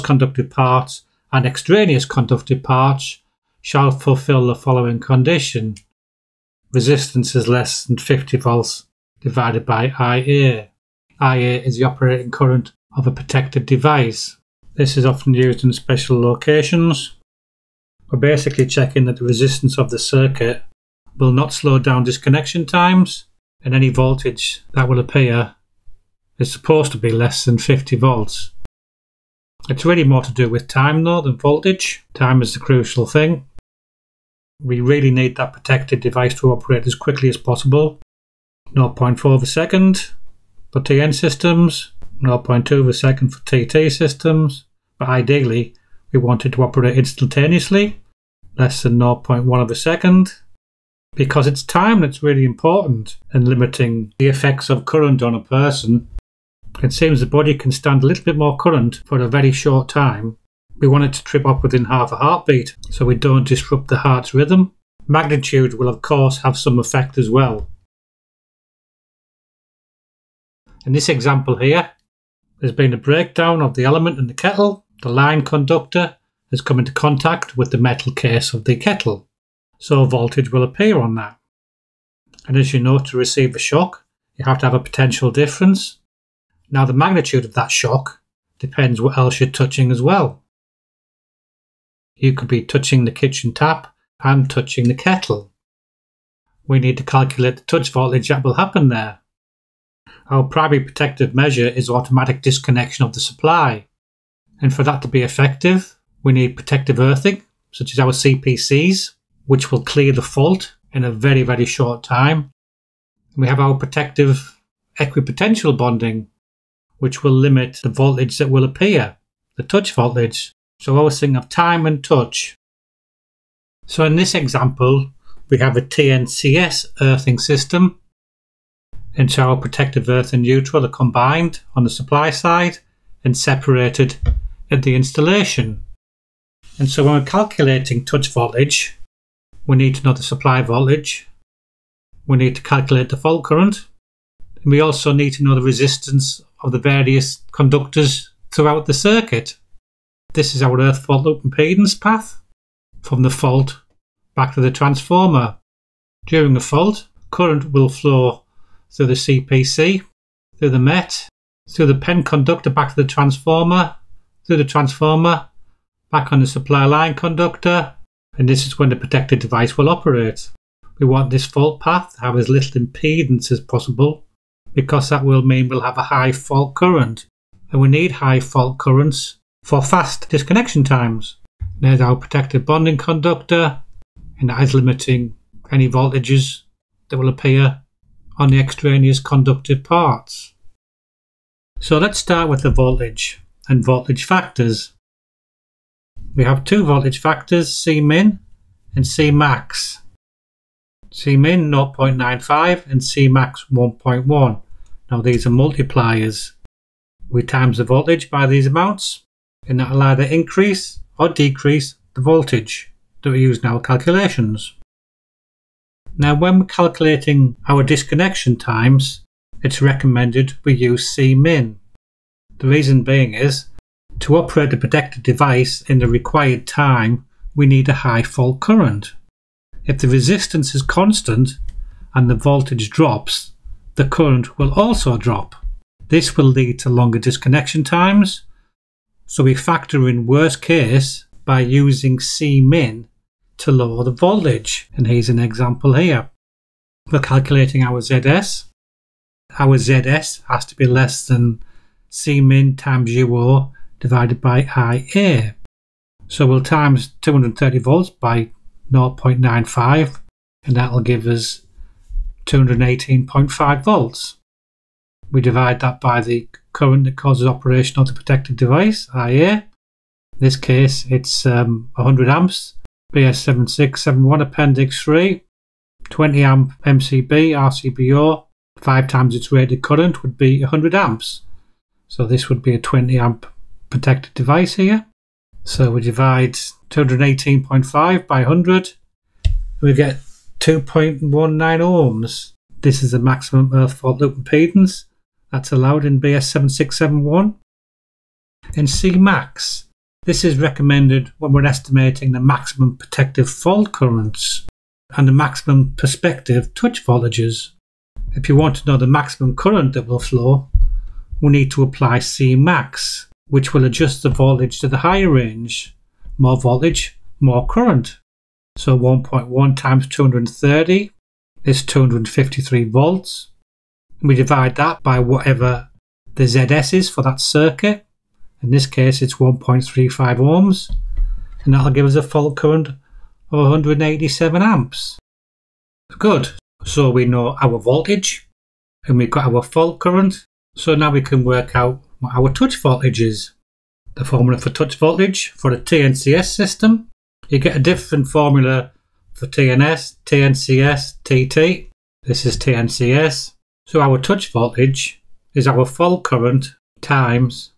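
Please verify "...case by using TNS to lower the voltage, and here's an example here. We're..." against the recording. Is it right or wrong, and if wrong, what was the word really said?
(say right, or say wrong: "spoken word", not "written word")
wrong: "Cmin", not "TNS".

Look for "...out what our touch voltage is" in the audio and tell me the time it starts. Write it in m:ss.
5:41.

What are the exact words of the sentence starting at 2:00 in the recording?
So I was thinking of time and touch.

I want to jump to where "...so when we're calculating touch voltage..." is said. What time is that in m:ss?
2:16.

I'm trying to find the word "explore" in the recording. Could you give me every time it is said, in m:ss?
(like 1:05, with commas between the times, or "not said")
not said.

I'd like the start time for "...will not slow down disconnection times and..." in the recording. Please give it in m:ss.
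0:21.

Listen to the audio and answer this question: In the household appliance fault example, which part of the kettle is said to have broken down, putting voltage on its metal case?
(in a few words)
The element.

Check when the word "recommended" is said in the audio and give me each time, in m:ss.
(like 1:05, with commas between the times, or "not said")
3:39, 5:00.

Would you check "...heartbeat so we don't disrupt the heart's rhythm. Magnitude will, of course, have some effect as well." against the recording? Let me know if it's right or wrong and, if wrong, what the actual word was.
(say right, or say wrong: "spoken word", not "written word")
right.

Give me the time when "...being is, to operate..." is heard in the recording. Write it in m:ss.
3:43.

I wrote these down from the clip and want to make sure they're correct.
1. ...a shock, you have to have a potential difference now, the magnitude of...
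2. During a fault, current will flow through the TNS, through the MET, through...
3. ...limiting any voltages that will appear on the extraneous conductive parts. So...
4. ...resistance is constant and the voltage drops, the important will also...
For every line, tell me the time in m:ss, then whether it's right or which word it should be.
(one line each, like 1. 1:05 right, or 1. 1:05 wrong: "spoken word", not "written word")
1. 1:23 right
2. 2:36 wrong: "CPC", not "TNS"
3. 3:04 right
4. 3:50 wrong: "current", not "important".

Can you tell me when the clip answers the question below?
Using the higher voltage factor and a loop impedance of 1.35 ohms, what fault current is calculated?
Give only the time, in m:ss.
5:33.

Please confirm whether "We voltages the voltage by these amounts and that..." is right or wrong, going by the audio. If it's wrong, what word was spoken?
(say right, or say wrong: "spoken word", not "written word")
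wrong: "times", not "voltages".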